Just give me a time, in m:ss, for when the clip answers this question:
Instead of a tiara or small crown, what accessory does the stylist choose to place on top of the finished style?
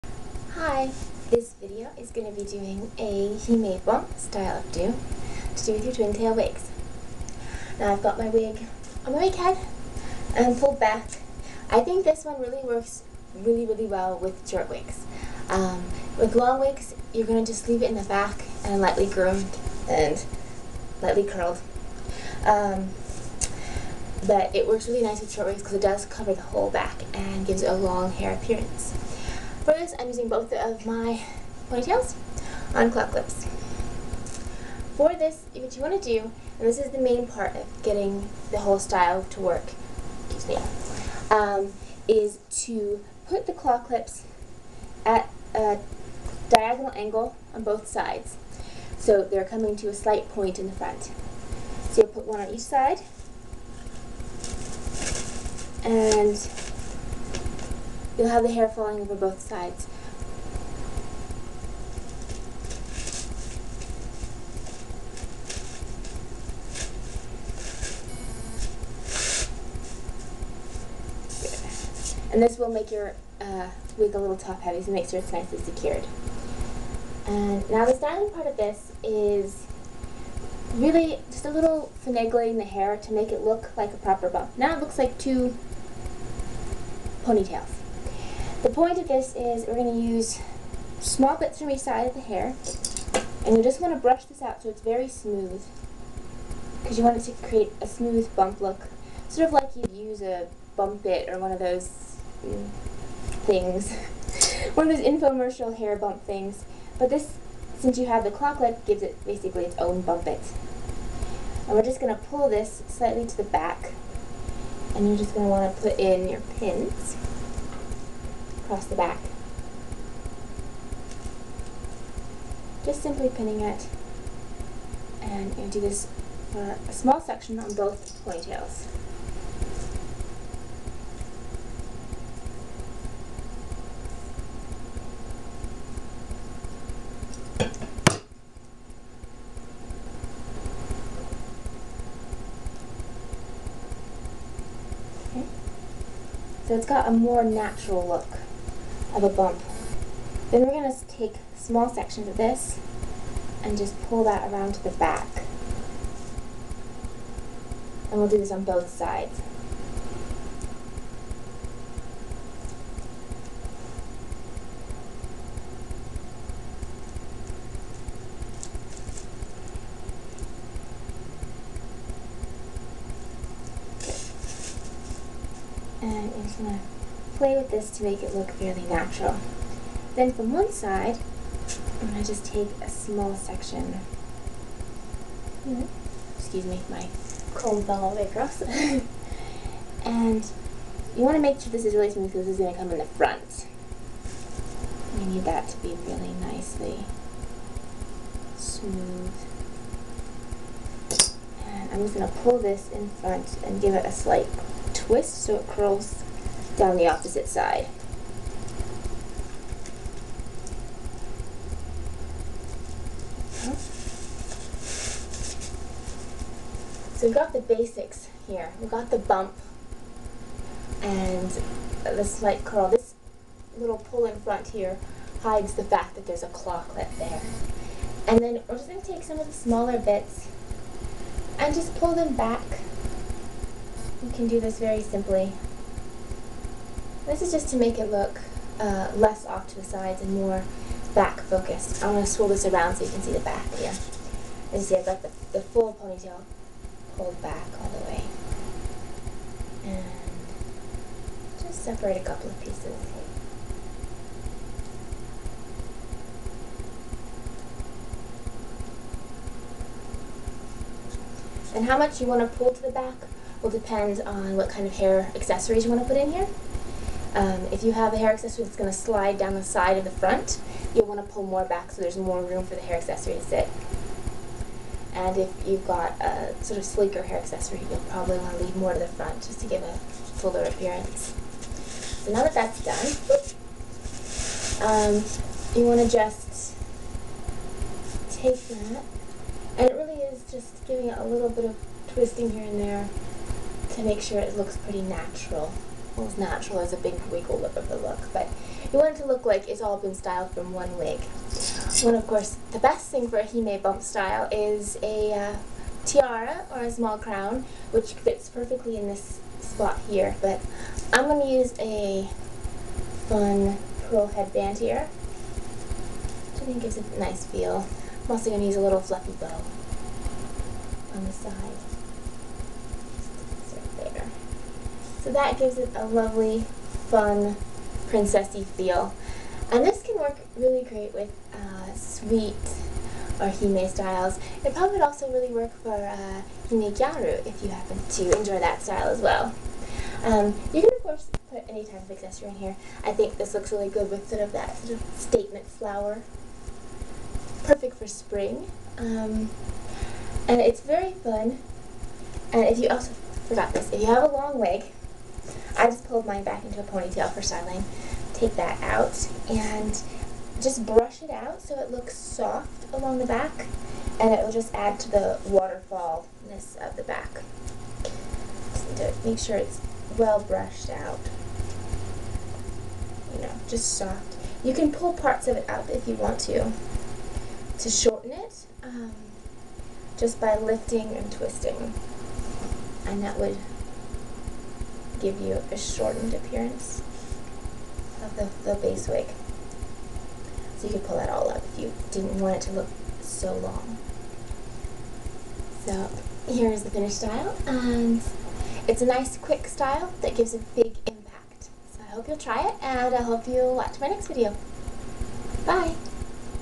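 5:14.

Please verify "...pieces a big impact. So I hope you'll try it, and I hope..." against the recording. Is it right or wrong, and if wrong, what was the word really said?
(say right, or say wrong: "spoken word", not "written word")
wrong: "gives", not "pieces".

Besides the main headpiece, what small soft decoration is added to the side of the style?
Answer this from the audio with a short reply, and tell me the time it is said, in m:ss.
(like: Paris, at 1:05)
fluffy bow, at 5:18.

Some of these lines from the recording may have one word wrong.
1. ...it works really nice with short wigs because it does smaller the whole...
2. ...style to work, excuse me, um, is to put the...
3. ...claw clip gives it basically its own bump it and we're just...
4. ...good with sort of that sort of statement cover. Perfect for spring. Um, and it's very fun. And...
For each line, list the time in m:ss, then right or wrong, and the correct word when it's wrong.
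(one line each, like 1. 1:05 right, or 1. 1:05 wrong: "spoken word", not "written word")
1. 0:24 wrong: "cover", not "smaller"
2. 0:38 right
3. 1:48 right
4. 5:43 wrong: "flower", not "cover".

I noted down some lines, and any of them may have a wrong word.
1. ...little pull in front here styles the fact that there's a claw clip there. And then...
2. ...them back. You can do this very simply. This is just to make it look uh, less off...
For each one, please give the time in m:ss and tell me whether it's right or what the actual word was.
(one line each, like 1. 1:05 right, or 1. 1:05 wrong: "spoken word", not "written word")
1. 3:43 wrong: "hides", not "styles"
2. 3:52 right.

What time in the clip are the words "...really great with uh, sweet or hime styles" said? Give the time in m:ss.
5:30.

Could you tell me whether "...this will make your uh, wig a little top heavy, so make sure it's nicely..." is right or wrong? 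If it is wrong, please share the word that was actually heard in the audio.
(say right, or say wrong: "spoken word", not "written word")
right.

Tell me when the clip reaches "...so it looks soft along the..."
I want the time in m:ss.
6:01.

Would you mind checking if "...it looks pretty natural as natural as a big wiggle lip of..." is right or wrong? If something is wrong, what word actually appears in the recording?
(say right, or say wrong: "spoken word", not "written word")
right.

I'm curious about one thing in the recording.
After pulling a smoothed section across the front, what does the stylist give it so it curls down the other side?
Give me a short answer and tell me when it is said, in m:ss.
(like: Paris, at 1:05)
a slight twist, at 3:24.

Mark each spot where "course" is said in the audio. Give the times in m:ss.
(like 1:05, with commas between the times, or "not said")
5:02, 5:41.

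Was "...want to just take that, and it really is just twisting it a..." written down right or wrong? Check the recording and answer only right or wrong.
wrong.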